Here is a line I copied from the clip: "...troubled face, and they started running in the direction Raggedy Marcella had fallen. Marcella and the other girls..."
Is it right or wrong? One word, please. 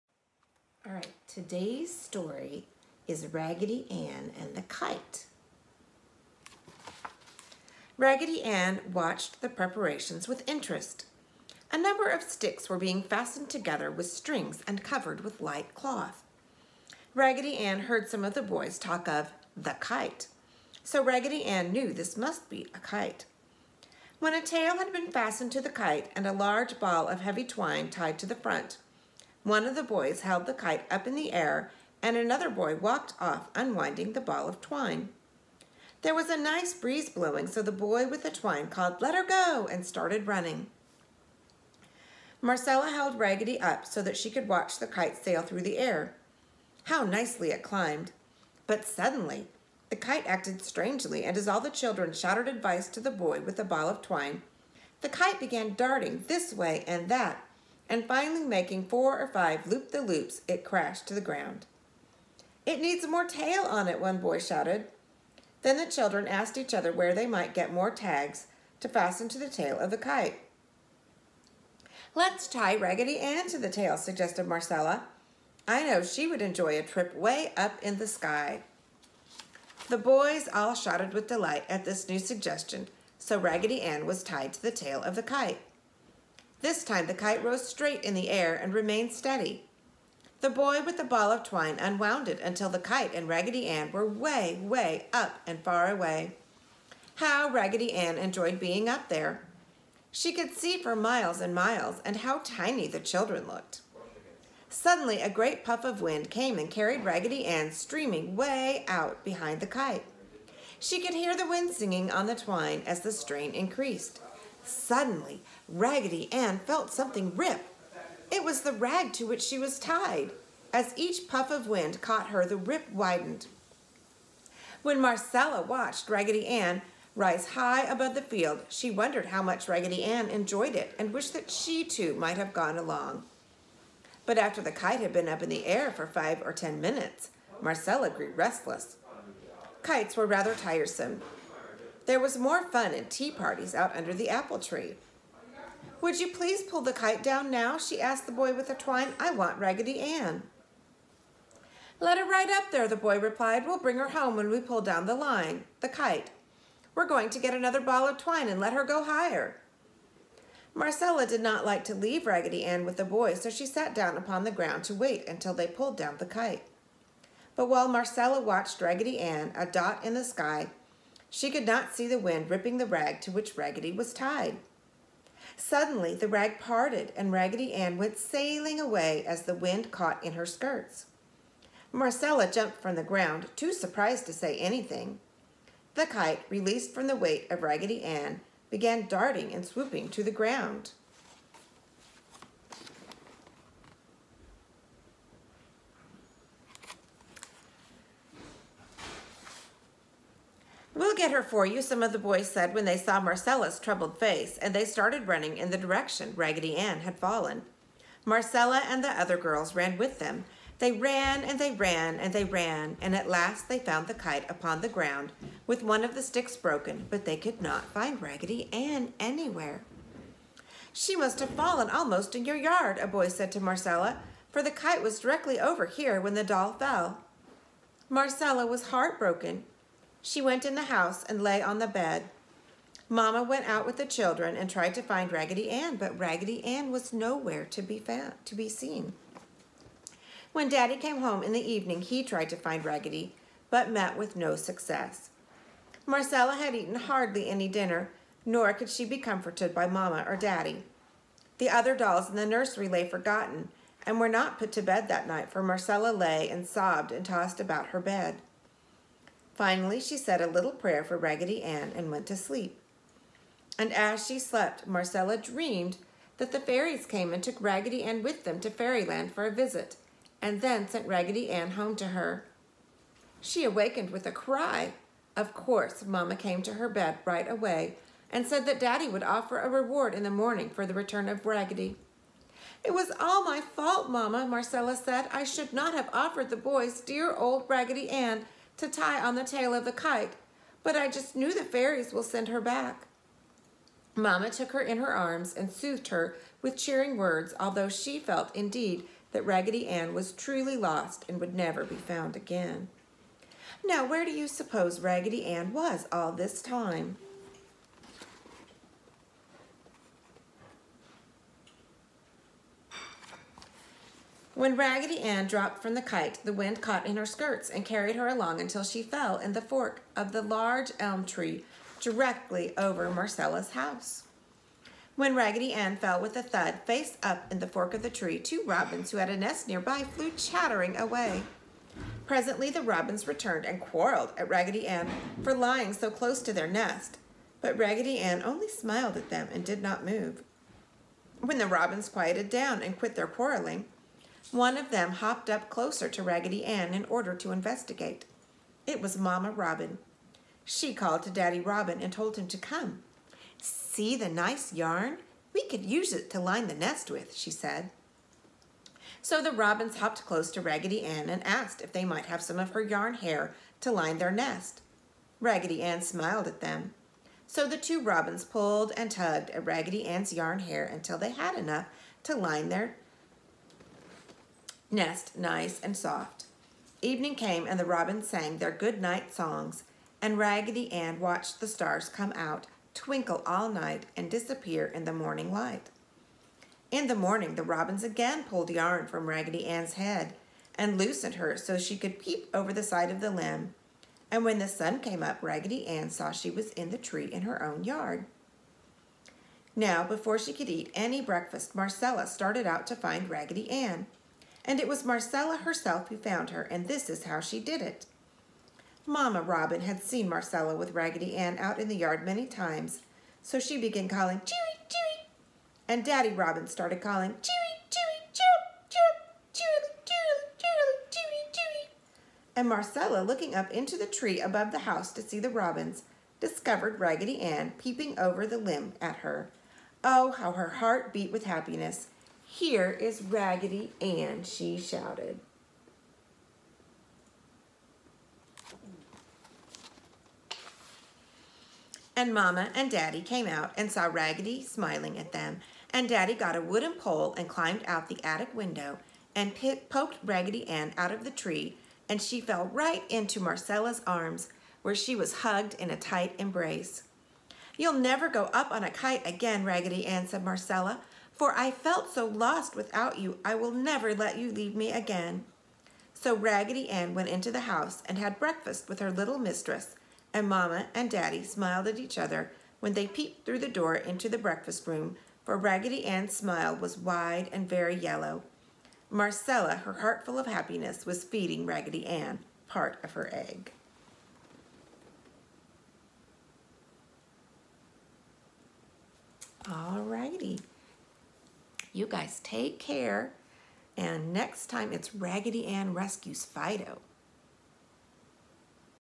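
wrong.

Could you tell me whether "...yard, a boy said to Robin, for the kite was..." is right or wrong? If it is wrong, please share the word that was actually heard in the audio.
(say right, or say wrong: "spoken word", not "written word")
wrong: "Marcella", not "Robin".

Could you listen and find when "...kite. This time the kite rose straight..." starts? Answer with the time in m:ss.
1:25.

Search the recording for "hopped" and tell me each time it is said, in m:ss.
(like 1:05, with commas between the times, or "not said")
5:45, 5:59.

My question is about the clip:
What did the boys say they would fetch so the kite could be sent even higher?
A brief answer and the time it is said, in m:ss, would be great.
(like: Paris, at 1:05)
another ball of twine, at 2:37.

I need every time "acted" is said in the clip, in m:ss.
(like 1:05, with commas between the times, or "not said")
0:50.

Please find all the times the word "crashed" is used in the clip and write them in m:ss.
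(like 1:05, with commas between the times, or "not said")
1:00.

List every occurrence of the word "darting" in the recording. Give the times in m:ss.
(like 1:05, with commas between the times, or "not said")
0:55, 3:09.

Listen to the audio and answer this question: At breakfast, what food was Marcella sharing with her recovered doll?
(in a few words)
egg.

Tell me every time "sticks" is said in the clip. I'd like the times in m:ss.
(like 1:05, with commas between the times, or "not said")
0:12, 3:36.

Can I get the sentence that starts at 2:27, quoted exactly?
She asked the boy with the twine.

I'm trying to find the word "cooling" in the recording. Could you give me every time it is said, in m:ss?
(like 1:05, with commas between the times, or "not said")
not said.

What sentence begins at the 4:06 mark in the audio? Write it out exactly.
Marcella had eaten hardly any dinner, nor could she be comforted by Mamma or Daddy.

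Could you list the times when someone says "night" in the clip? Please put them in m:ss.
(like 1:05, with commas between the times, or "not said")
4:15, 6:19, 6:23.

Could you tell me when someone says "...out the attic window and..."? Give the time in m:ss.
7:27.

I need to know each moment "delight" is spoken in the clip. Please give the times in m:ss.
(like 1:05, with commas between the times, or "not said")
1:21.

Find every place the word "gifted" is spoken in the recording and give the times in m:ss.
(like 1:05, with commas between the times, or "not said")
not said.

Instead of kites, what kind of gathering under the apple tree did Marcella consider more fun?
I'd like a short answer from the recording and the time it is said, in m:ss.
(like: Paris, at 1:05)
tea parties, at 2:23.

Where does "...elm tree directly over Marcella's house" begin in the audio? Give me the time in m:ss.
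5:20.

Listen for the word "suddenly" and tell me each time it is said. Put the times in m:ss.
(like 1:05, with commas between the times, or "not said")
0:48, 1:44, 1:54, 2:55.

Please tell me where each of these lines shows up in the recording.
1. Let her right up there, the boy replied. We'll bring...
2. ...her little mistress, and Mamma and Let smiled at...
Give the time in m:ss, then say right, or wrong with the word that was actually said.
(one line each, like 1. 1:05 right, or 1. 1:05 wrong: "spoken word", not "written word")
1. 2:32 right
2. 7:48 wrong: "Daddy", not "Let".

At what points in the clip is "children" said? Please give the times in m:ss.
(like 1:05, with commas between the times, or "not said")
0:51, 1:05, 1:42, 3:54.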